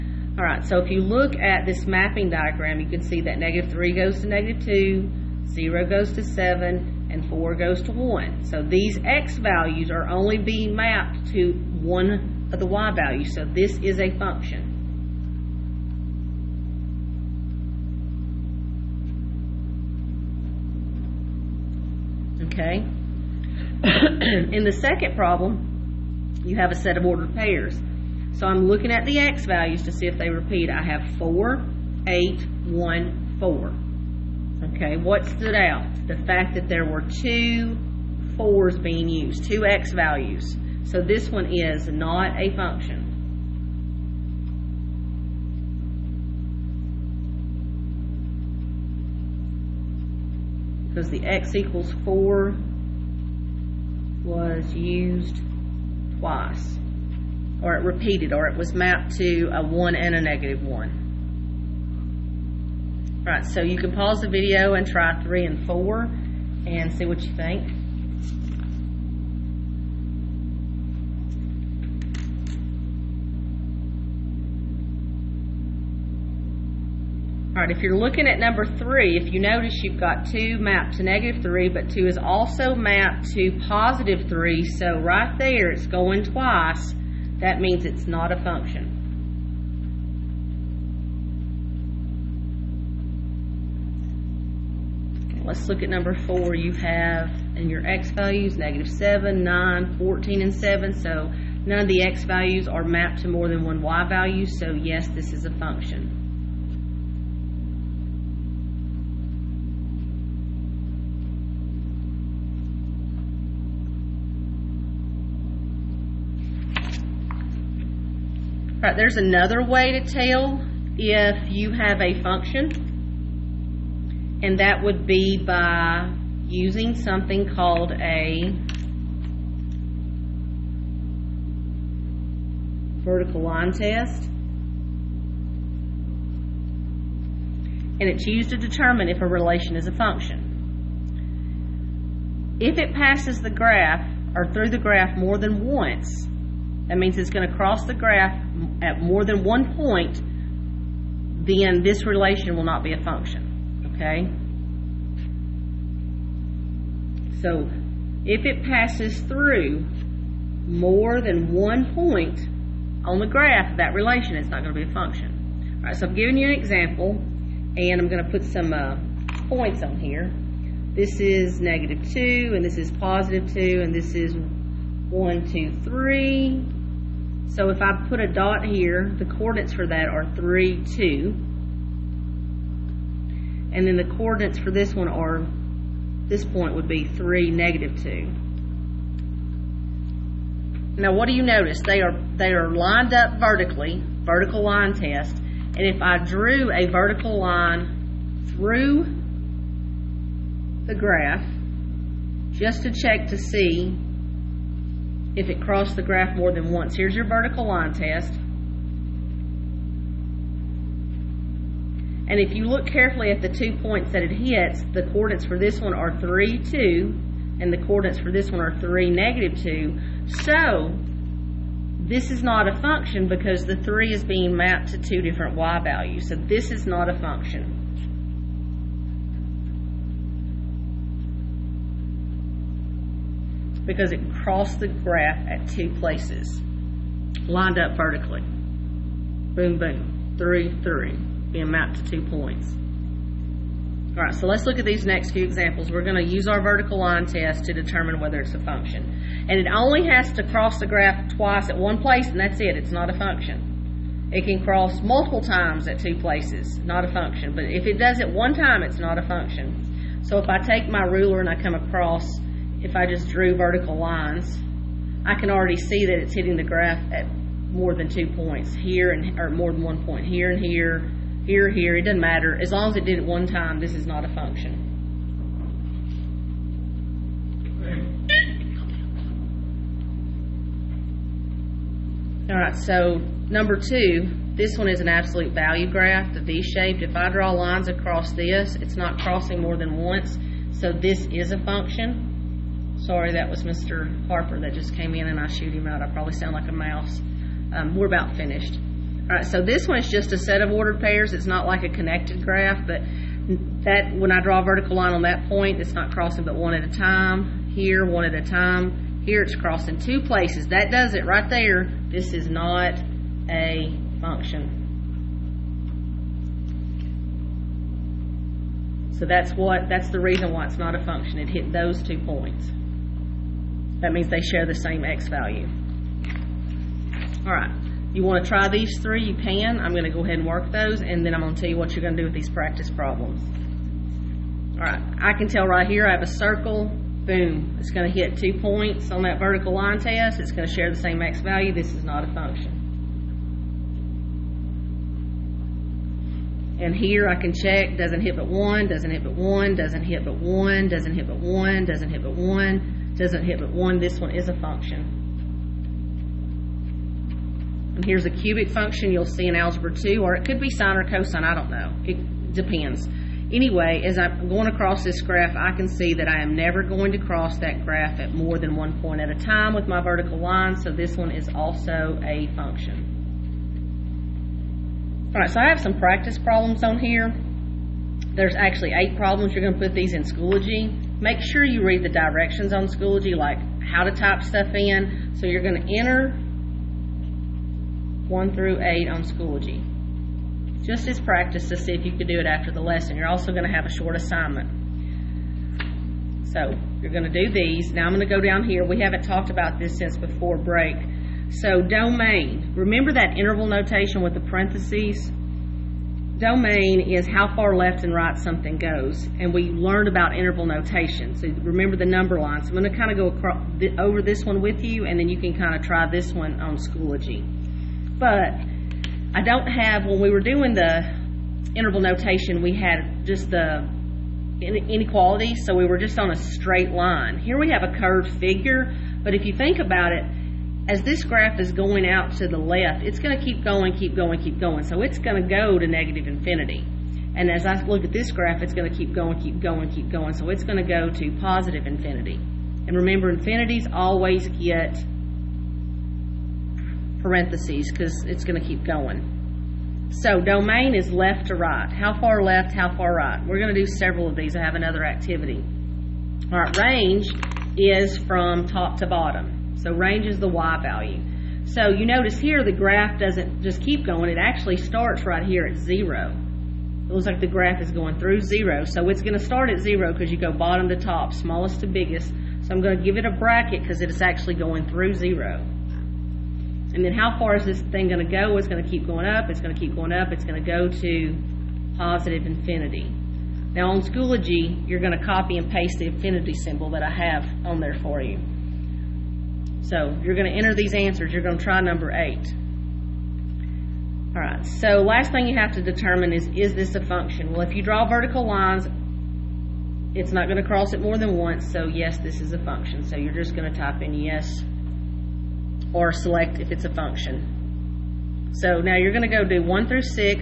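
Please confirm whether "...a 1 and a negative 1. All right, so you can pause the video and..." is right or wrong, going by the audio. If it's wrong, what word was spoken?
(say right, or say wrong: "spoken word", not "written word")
right.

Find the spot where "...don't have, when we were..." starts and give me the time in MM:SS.
06:59.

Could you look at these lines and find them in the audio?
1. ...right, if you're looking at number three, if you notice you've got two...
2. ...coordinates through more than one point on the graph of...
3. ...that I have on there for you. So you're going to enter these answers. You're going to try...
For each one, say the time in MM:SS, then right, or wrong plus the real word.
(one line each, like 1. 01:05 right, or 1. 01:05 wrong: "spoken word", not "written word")
1. 01:17 right
2. 02:38 wrong: "passes", not "coordinates"
3. 08:06 right.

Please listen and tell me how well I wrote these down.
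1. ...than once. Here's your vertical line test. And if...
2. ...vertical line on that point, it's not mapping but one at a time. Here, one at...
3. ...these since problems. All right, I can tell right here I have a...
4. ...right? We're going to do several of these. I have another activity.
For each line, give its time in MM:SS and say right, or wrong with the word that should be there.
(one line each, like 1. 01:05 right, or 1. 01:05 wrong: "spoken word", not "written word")
1. 03:26 right
2. 05:04 wrong: "crossing", not "mapping"
3. 05:32 wrong: "practice", not "since"
4. 07:33 right.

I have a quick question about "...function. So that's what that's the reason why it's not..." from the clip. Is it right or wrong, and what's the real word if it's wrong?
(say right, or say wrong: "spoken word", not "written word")
right.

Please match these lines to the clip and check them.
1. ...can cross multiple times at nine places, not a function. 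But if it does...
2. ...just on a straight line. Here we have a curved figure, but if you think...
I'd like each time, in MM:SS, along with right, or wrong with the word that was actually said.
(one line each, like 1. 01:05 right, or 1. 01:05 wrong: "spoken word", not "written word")
1. 04:14 wrong: "two", not "nine"
2. 07:05 right.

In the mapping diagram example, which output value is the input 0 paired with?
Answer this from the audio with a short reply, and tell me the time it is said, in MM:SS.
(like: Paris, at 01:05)
7, at 00:05.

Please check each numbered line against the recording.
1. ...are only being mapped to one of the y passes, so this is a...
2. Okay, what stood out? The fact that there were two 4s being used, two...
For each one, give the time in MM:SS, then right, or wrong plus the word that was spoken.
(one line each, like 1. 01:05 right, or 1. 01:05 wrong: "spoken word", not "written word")
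1. 00:09 wrong: "values", not "passes"
2. 00:34 right.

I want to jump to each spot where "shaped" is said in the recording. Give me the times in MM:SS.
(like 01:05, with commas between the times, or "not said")
04:46.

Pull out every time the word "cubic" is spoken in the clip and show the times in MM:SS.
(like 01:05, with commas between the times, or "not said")
05:58.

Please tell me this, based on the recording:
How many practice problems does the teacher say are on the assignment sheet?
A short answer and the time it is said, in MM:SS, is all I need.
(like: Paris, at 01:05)
8, at 06:19.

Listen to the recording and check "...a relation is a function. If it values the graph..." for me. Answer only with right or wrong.
wrong.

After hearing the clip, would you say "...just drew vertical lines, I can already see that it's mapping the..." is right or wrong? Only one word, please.
wrong.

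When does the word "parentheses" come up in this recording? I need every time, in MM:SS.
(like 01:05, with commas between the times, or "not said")
06:44, 07:27.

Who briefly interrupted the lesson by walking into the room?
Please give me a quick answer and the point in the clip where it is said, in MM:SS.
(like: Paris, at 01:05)
Mr. Harper, at 04:53.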